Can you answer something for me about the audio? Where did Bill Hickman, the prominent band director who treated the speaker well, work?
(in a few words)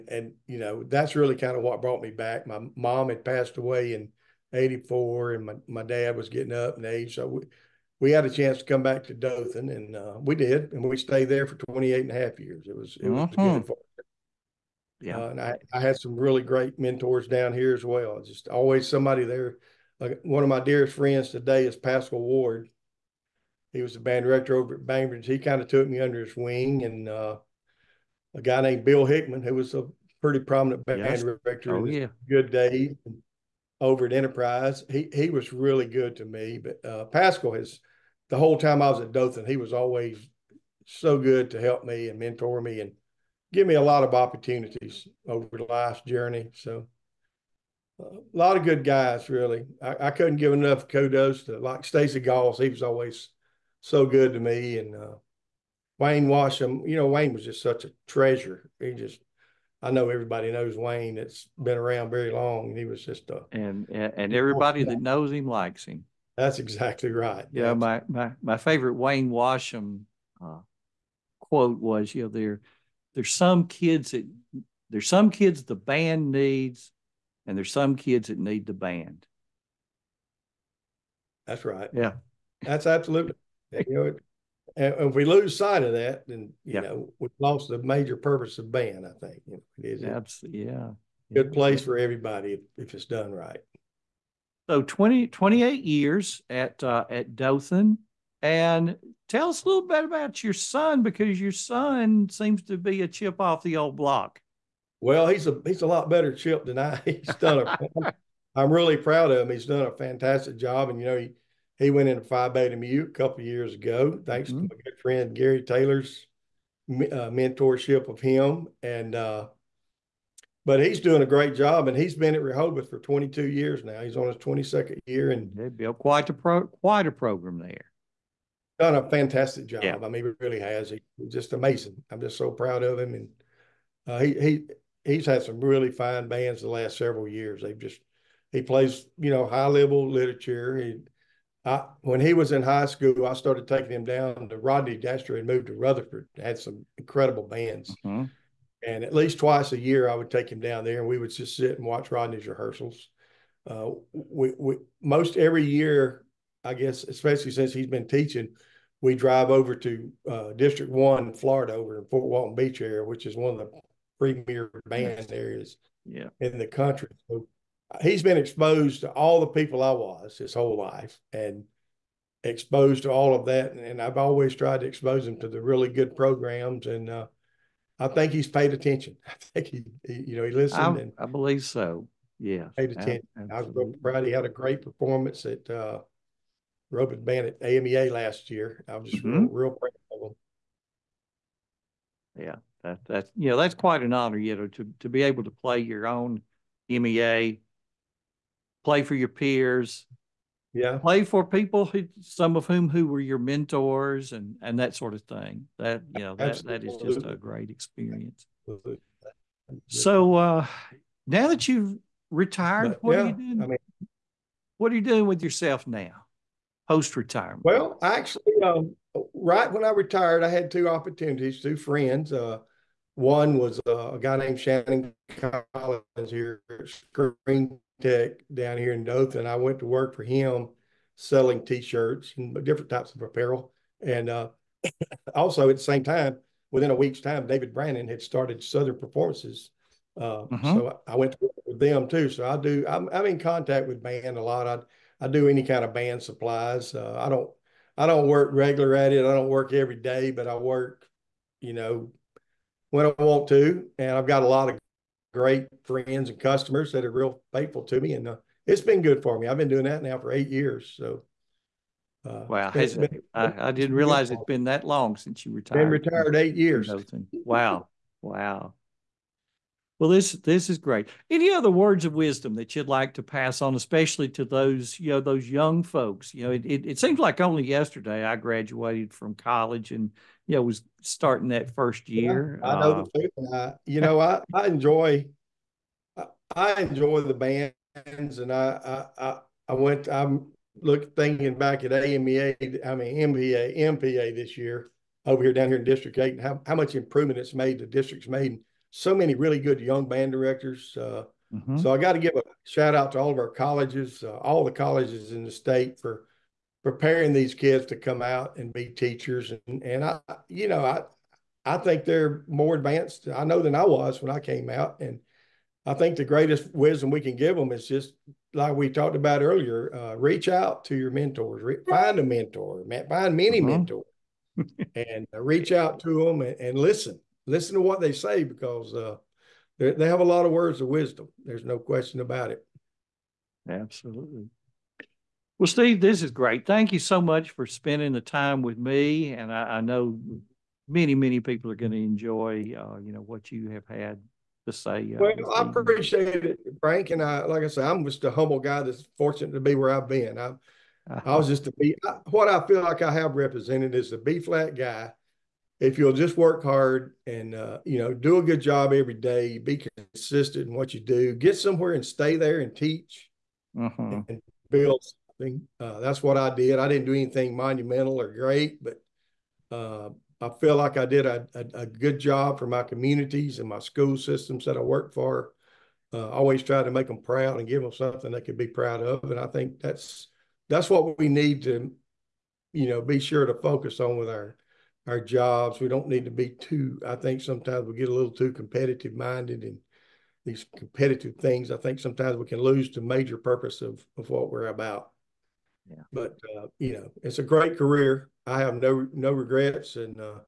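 Enterprise.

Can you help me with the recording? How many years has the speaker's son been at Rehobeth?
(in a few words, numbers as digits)
22.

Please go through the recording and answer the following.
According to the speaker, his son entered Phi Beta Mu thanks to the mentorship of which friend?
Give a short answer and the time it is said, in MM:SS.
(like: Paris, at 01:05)
Gary Taylor, at 01:55.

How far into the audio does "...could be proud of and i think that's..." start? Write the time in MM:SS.
06:18.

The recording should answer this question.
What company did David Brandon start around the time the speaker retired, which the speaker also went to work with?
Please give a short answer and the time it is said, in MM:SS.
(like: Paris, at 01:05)
Southern Performances, at 03:58.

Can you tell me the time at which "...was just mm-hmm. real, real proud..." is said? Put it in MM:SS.
03:08.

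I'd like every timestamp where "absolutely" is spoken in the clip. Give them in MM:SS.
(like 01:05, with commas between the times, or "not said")
01:22, 01:30, 03:03, 03:28, 05:33.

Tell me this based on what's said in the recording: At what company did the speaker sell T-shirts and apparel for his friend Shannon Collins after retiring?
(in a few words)
Screen Tech.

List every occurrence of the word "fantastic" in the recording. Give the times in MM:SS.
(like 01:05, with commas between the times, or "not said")
01:49, 02:09.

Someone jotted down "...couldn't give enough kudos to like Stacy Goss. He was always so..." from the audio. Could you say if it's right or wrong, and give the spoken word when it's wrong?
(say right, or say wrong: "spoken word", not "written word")
right.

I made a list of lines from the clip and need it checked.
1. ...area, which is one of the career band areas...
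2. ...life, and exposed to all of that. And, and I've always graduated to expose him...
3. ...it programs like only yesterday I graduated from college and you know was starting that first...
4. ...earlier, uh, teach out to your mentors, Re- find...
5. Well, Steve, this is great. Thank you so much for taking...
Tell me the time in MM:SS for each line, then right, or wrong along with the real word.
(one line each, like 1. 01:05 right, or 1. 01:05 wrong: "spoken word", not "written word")
1. 02:42 wrong: "premier", not "career"
2. 02:50 wrong: "tried", not "graduated"
3. 04:36 wrong: "seems", not "programs"
4. 05:19 wrong: "reach", not "teach"
5. 05:35 wrong: "spending", not "taking".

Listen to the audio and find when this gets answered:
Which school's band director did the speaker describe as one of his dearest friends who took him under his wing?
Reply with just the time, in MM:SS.
00:24.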